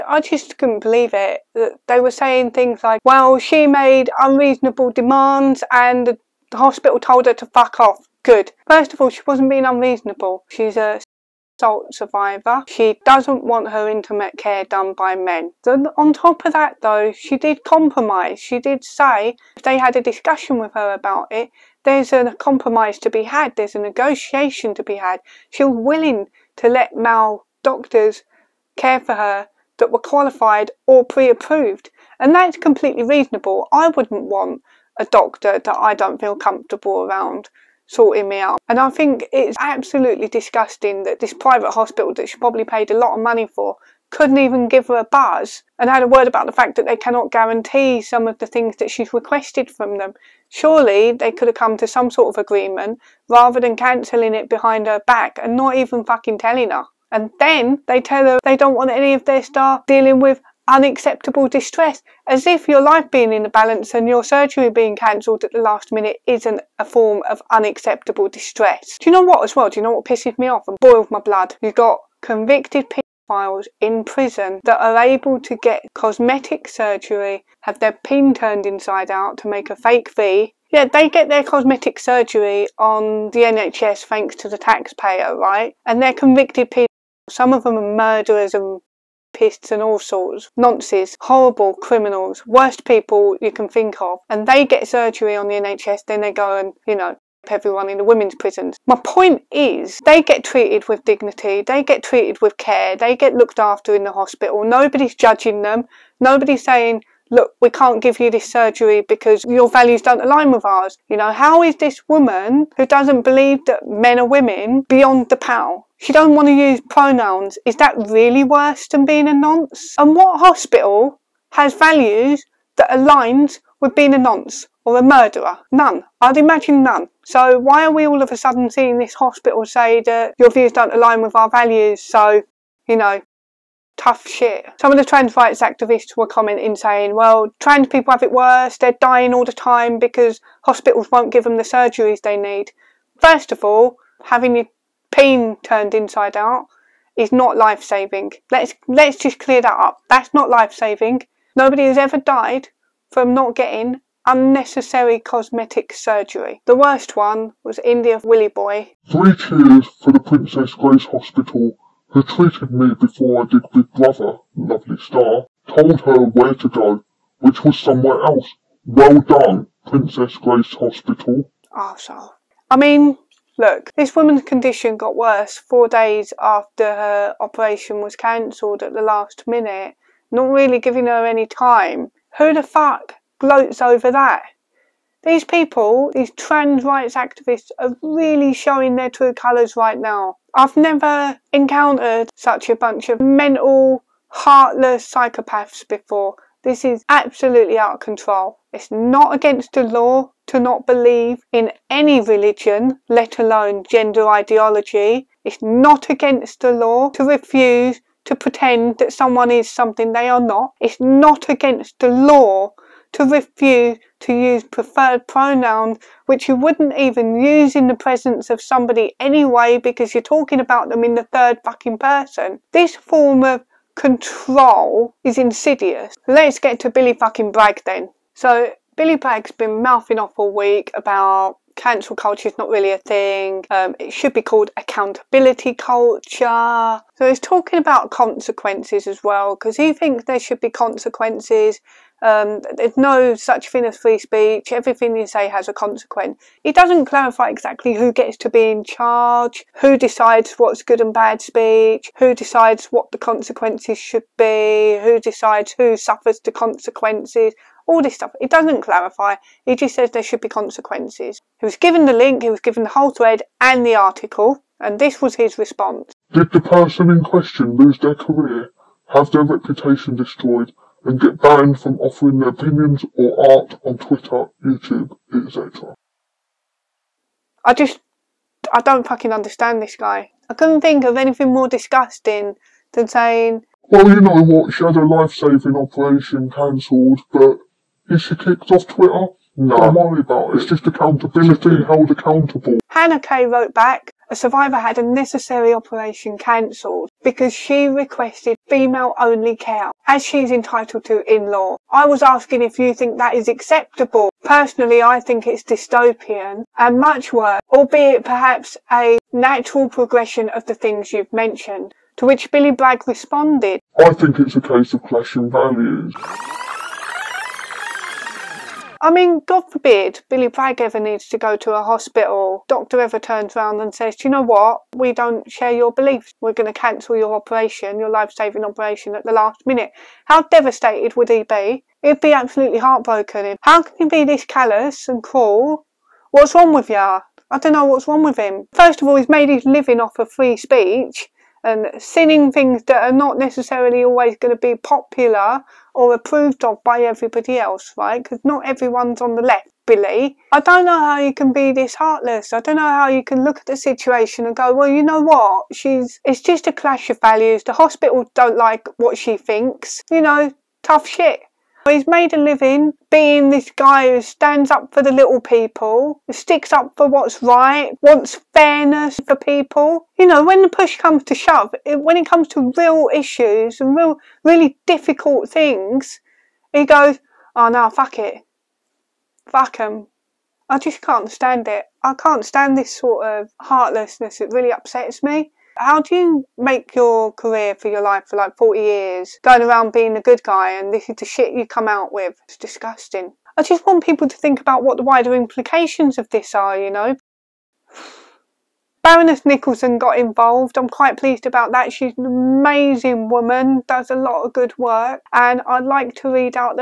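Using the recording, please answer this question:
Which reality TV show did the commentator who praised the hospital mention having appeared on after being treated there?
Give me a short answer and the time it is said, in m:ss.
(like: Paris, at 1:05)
Big Brother, at 2:43.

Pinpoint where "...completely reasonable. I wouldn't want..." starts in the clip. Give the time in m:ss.
0:32.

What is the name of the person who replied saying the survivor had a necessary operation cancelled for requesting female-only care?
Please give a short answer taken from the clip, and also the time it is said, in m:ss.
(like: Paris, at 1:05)
Hannah Kay, at 4:52.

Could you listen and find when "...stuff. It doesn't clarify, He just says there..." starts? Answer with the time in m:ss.
4:18.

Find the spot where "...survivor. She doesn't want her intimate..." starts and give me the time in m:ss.
0:11.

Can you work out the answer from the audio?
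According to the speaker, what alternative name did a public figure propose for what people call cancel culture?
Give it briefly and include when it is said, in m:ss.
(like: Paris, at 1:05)
accountability culture, at 3:54.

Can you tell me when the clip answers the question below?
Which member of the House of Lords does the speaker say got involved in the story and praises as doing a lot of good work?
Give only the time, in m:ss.
6:39.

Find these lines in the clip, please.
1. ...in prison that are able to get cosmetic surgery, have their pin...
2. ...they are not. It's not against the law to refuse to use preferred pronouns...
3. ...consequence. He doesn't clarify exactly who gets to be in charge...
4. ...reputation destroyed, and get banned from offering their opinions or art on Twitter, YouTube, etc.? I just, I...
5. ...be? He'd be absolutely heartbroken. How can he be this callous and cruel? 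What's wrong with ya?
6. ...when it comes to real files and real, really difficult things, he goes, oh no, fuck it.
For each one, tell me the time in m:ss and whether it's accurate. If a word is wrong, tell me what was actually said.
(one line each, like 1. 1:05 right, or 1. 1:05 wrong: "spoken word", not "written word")
1. 1:13 right
2. 3:30 right
3. 4:05 right
4. 4:29 right
5. 5:31 right
6. 6:11 wrong: "issues", not "files".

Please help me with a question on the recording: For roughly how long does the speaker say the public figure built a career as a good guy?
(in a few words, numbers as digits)
40 years.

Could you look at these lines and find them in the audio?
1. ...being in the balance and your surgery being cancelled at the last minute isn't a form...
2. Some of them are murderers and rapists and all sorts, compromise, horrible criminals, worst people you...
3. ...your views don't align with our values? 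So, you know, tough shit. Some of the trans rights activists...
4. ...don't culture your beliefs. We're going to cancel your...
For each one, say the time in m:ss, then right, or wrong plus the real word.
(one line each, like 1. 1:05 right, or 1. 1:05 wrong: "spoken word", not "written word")
1. 1:03 right
2. 1:27 wrong: "nonsense", not "compromise"
3. 2:10 right
4. 5:25 wrong: "share", not "culture".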